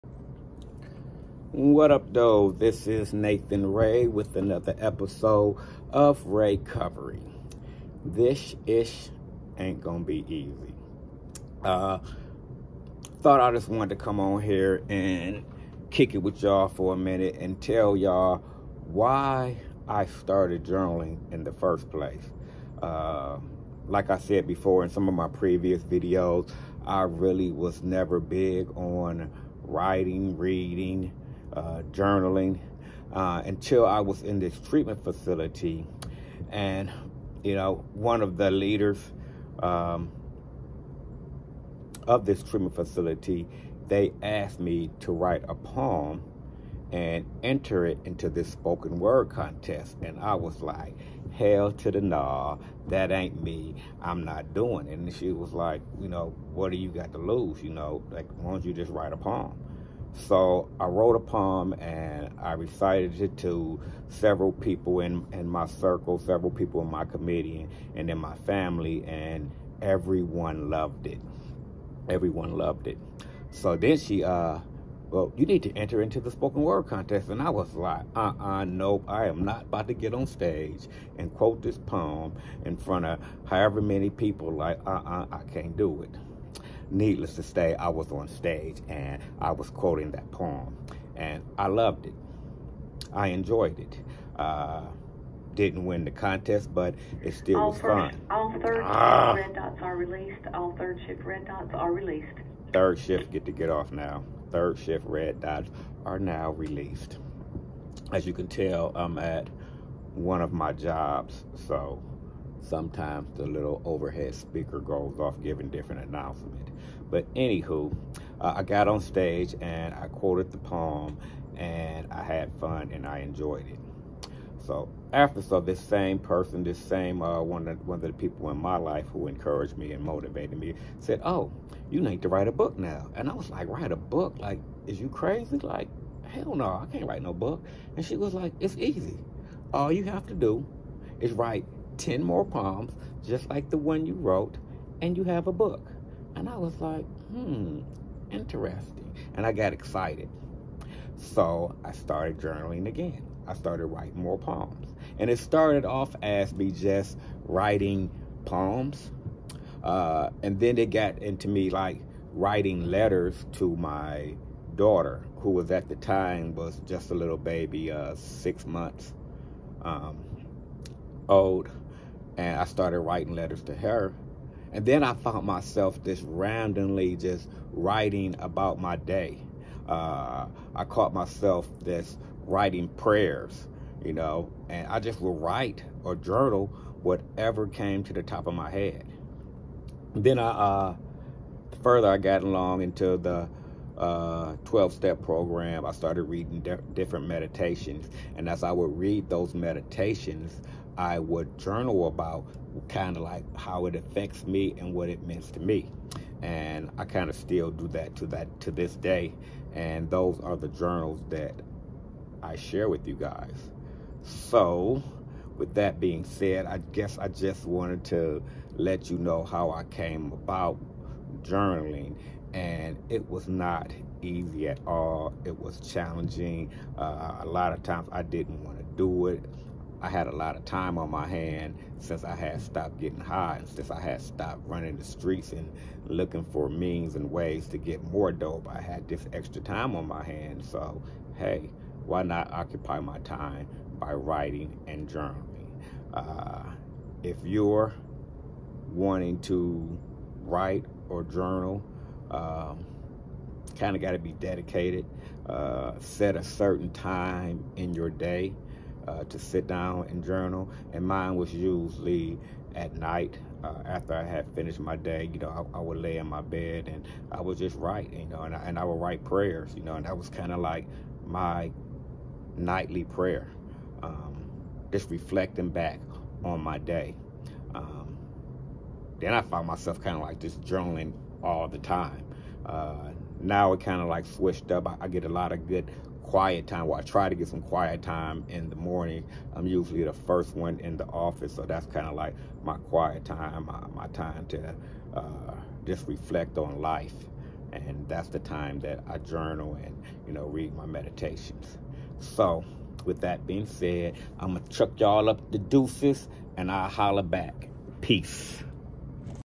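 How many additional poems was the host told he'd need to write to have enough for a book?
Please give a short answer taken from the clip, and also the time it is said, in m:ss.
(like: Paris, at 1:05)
10, at 2:22.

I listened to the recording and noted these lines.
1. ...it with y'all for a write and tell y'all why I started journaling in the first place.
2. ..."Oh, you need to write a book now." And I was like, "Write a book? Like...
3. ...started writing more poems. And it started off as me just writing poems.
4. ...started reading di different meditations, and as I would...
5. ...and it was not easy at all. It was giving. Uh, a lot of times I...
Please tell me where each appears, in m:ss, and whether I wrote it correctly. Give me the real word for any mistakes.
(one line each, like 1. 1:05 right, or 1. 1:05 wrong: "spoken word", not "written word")
1. 0:16 wrong: "minute", not "write"
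2. 2:11 right
3. 2:33 right
4. 3:15 right
5. 3:42 wrong: "challenging", not "giving".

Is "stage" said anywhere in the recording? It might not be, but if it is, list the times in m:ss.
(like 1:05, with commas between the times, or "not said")
1:20, 1:28, 1:59.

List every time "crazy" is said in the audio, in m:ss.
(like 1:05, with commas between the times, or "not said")
2:15.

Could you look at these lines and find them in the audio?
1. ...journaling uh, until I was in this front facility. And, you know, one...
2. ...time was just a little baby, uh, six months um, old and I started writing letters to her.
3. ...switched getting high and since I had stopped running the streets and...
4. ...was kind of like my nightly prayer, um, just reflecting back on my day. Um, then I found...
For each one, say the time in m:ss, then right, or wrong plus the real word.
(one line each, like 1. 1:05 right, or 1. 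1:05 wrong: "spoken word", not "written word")
1. 0:31 wrong: "treatment", not "front"
2. 2:45 right
3. 3:52 wrong: "stopped", not "switched"
4. 4:30 right.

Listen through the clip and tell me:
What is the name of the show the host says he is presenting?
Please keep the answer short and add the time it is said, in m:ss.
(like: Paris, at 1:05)
Raycovery, at 0:06.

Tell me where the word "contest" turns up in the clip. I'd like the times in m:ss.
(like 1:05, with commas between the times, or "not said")
0:49, 1:16, 1:36.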